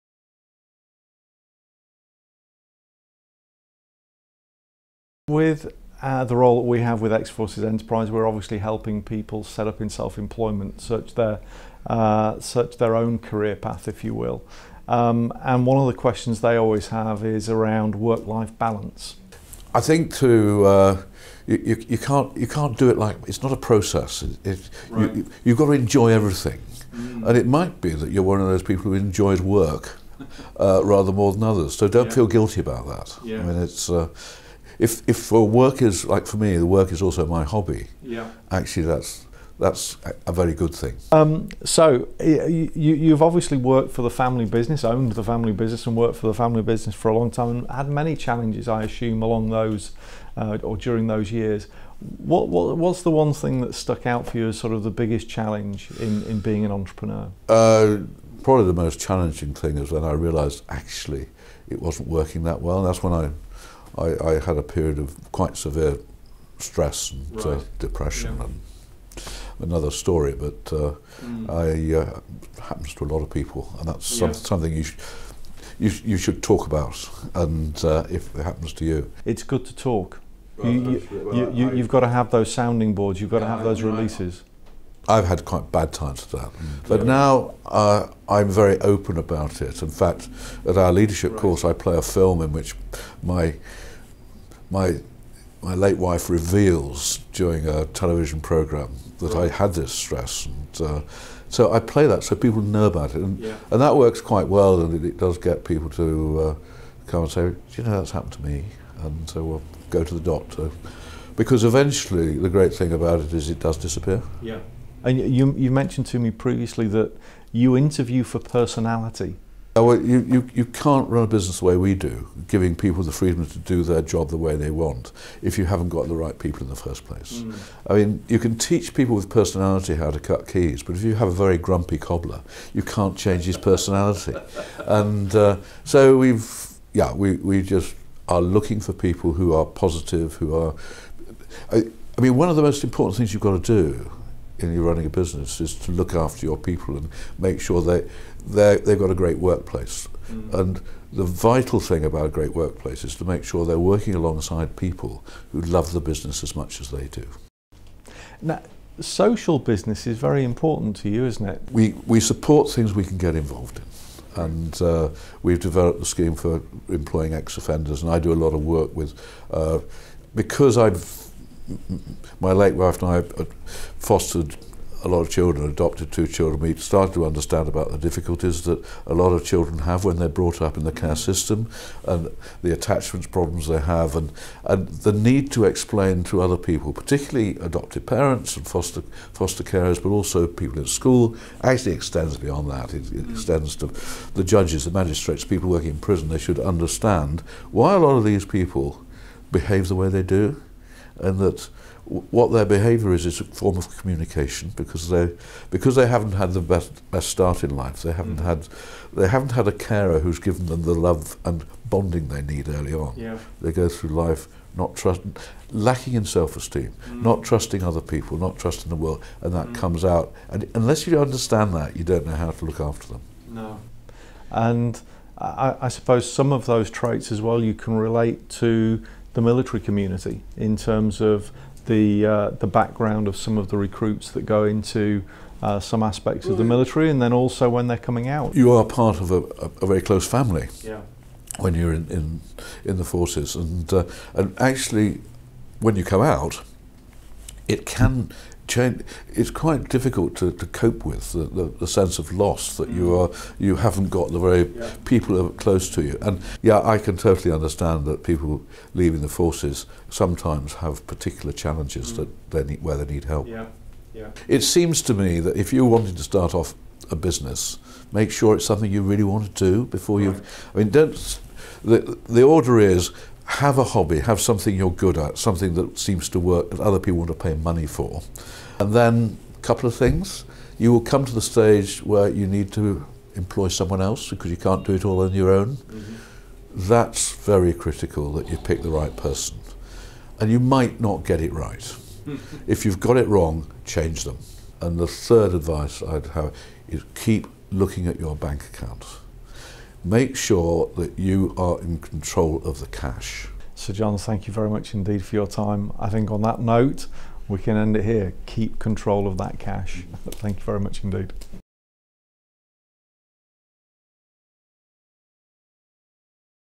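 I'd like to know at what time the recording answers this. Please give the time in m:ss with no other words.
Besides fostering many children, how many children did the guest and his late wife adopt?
2:56.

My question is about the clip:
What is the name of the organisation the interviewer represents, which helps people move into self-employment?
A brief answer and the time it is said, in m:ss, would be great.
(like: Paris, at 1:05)
X Forces Enterprise, at 0:07.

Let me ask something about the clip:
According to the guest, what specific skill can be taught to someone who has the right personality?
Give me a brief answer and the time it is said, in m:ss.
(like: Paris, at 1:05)
How to cut keys, at 2:10.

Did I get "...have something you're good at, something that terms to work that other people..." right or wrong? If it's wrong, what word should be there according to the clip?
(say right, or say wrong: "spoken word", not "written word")
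wrong: "seems", not "terms".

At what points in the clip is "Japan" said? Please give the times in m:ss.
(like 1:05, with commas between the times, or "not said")
not said.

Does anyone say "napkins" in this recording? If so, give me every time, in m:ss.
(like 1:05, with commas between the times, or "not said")
not said.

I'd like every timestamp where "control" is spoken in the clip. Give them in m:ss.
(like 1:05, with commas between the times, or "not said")
5:01, 5:08.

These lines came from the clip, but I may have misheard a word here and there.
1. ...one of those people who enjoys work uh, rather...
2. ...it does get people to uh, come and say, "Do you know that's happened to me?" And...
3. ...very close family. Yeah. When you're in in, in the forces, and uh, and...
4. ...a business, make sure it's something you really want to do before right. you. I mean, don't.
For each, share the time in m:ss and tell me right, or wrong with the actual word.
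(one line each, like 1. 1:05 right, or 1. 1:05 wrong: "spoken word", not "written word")
1. 0:28 right
2. 1:45 right
3. 3:59 right
4. 4:27 right.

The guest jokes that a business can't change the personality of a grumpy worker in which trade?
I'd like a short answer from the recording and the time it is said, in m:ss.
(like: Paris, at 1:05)
Cobbler, at 2:11.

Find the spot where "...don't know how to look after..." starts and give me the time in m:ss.
3:42.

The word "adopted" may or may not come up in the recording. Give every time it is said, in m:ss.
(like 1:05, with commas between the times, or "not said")
2:55, 3:07.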